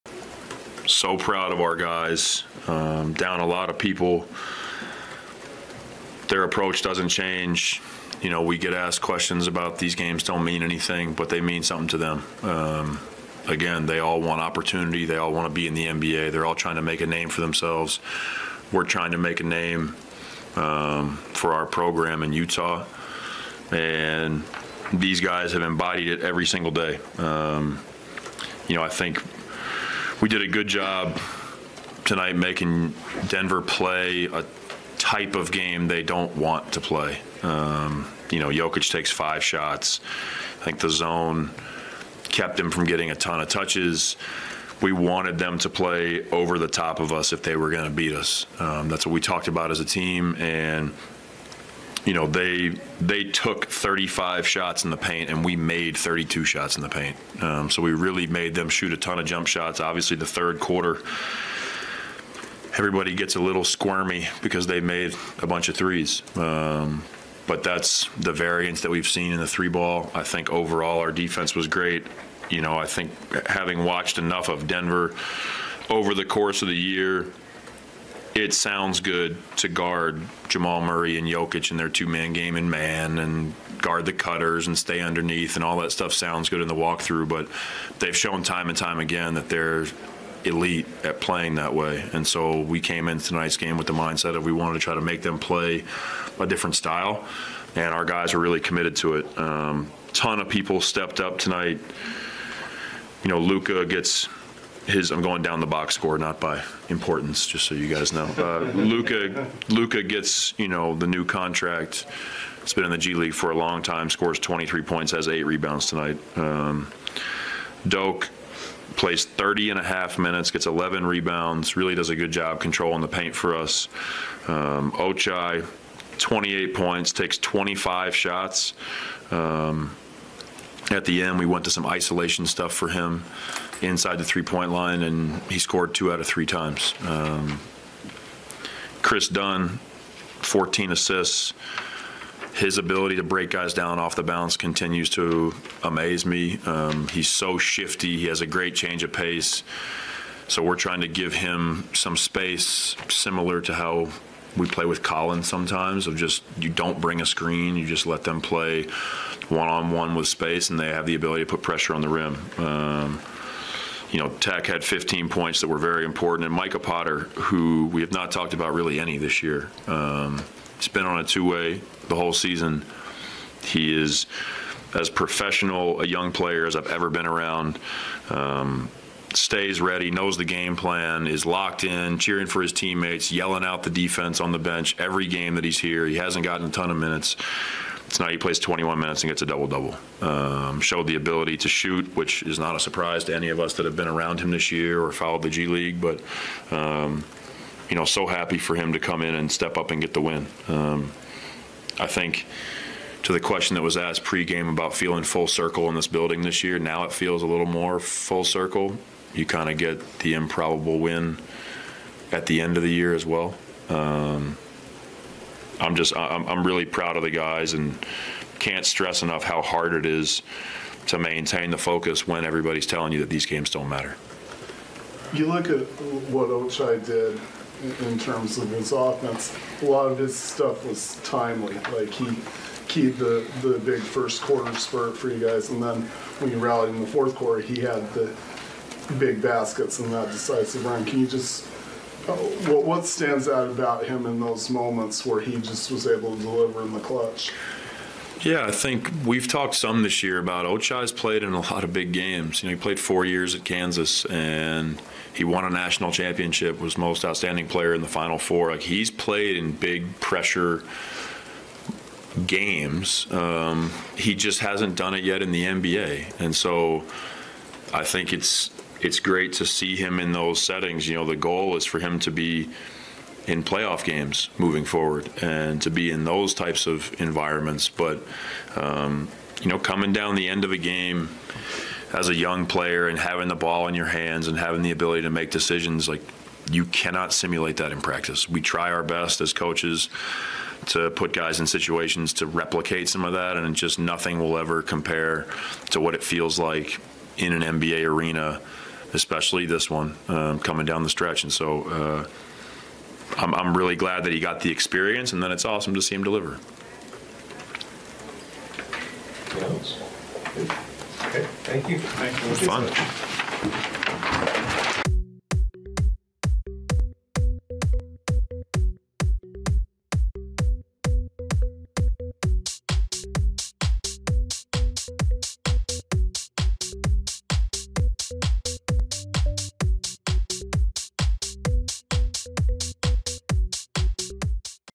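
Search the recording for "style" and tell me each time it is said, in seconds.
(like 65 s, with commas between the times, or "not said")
96 s.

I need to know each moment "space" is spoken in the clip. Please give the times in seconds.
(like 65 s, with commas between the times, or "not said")
152 s, 160 s.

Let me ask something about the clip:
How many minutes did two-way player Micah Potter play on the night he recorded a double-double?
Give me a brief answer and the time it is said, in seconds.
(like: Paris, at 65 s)
21, at 188 s.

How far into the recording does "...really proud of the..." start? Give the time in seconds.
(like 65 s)
216 s.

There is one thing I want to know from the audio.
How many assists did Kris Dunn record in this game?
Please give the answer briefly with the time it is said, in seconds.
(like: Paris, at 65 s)
14, at 140 s.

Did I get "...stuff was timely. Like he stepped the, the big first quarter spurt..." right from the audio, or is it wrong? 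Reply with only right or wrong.
wrong.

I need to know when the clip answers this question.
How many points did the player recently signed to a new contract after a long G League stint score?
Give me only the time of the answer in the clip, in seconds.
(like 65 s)
114 s.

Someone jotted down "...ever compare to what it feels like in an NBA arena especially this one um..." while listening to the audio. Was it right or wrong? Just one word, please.
right.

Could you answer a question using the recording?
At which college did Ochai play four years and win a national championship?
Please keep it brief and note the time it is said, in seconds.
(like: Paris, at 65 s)
Kansas, at 253 s.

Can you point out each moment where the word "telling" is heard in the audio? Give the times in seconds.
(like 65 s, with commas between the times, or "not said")
222 s.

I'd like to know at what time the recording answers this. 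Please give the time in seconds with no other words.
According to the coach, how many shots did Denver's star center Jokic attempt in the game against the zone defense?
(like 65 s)
39 s.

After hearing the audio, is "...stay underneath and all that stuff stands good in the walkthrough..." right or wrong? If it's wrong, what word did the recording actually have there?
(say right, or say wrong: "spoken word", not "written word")
wrong: "sounds", not "stands".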